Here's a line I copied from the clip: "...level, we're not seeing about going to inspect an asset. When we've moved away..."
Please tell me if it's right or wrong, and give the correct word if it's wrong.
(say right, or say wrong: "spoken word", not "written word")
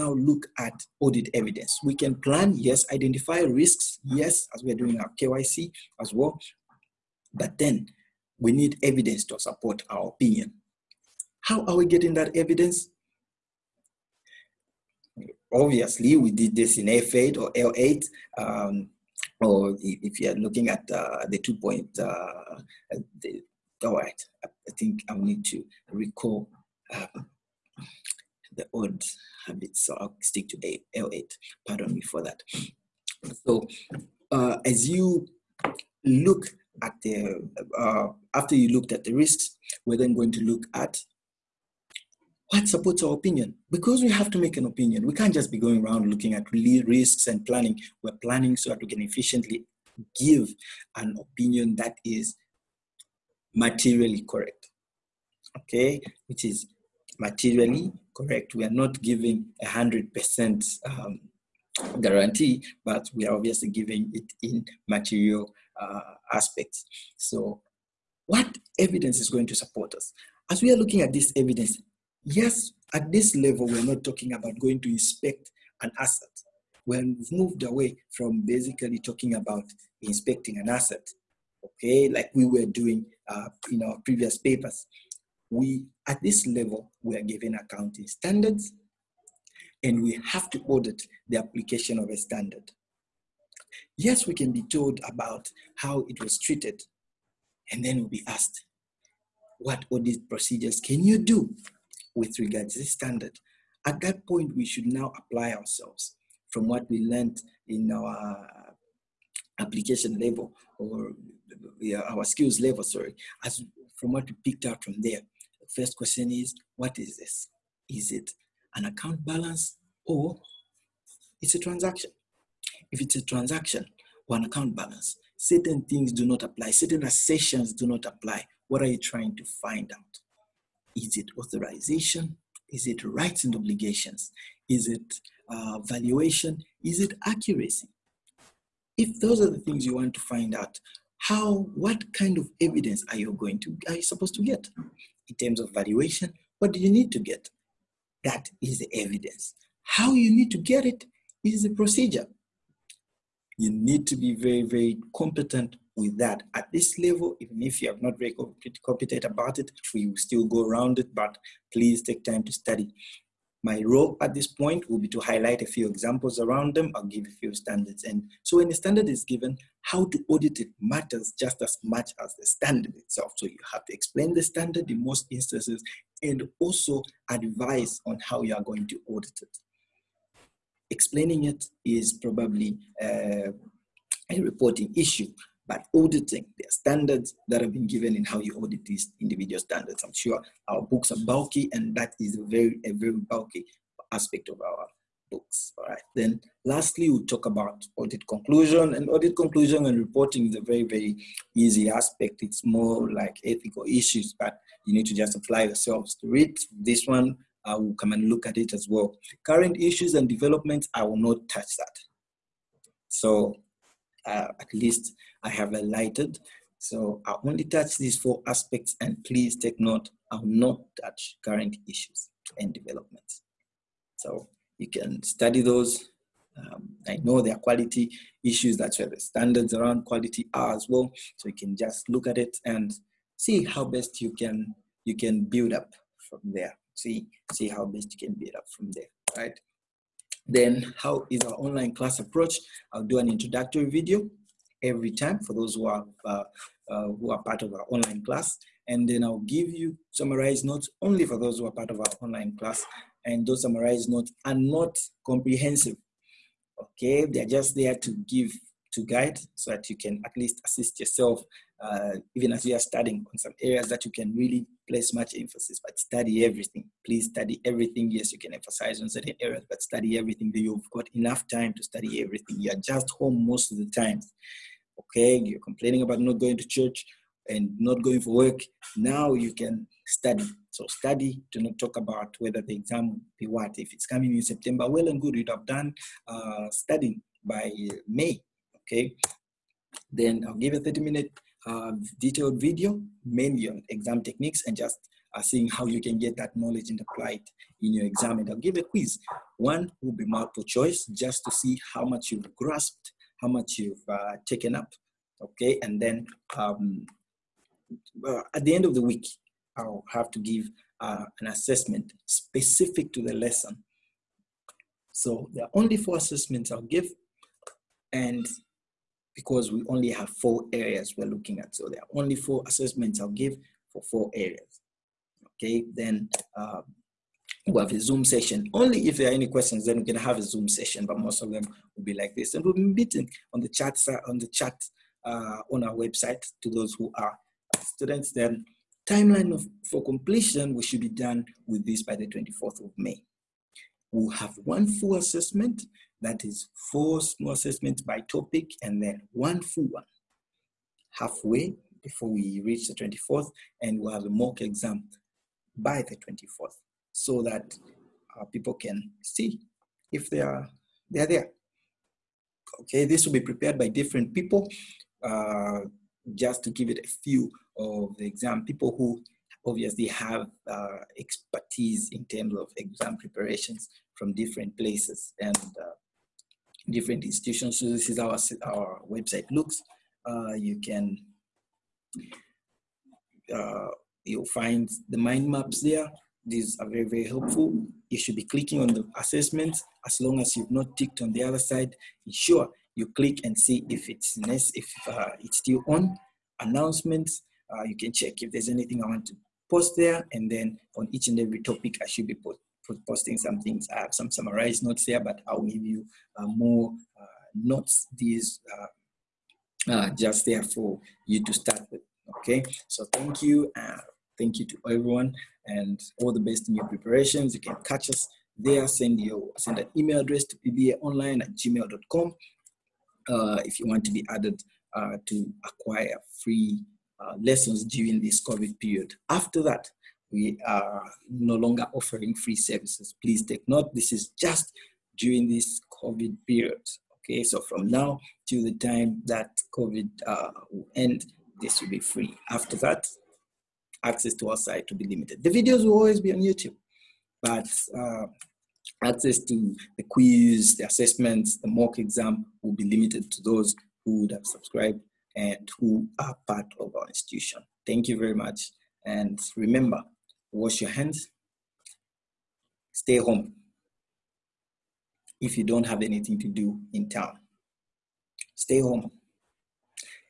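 wrong: "talking", not "seeing".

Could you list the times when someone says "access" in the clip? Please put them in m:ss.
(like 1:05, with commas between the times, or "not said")
7:24, 7:29.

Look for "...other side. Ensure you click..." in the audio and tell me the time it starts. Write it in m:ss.
6:31.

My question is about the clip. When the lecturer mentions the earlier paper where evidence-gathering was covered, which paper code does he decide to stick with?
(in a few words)
L8.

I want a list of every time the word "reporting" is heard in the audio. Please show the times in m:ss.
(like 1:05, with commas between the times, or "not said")
3:04, 3:19.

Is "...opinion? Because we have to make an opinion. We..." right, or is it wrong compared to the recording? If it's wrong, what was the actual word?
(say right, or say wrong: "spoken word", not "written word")
right.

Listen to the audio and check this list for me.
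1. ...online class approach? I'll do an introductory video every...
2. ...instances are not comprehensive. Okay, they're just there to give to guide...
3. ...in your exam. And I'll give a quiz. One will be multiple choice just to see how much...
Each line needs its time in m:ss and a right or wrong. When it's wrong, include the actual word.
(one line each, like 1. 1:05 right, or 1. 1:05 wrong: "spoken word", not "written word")
1. 4:01 right
2. 4:14 wrong: "notes", not "instances"
3. 4:57 right.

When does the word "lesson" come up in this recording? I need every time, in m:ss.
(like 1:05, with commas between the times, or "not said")
5:13, 7:07.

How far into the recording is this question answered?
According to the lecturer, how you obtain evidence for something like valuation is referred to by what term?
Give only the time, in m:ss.
2:31.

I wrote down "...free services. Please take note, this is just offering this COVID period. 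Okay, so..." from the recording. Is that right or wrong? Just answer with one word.
wrong.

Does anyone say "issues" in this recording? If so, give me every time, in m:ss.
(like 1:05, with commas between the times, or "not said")
3:04, 3:23, 3:29, 3:41, 3:48.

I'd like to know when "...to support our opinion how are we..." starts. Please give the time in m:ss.
0:09.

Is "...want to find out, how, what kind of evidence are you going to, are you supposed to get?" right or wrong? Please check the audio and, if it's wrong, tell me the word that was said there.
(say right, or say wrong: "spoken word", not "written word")
right.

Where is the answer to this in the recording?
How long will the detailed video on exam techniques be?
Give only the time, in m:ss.
4:50.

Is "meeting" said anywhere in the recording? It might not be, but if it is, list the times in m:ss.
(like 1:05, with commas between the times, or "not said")
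5:32.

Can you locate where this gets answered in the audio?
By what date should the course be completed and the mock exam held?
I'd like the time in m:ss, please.
5:42.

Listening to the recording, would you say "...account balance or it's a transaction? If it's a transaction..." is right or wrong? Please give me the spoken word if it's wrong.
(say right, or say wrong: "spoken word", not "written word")
right.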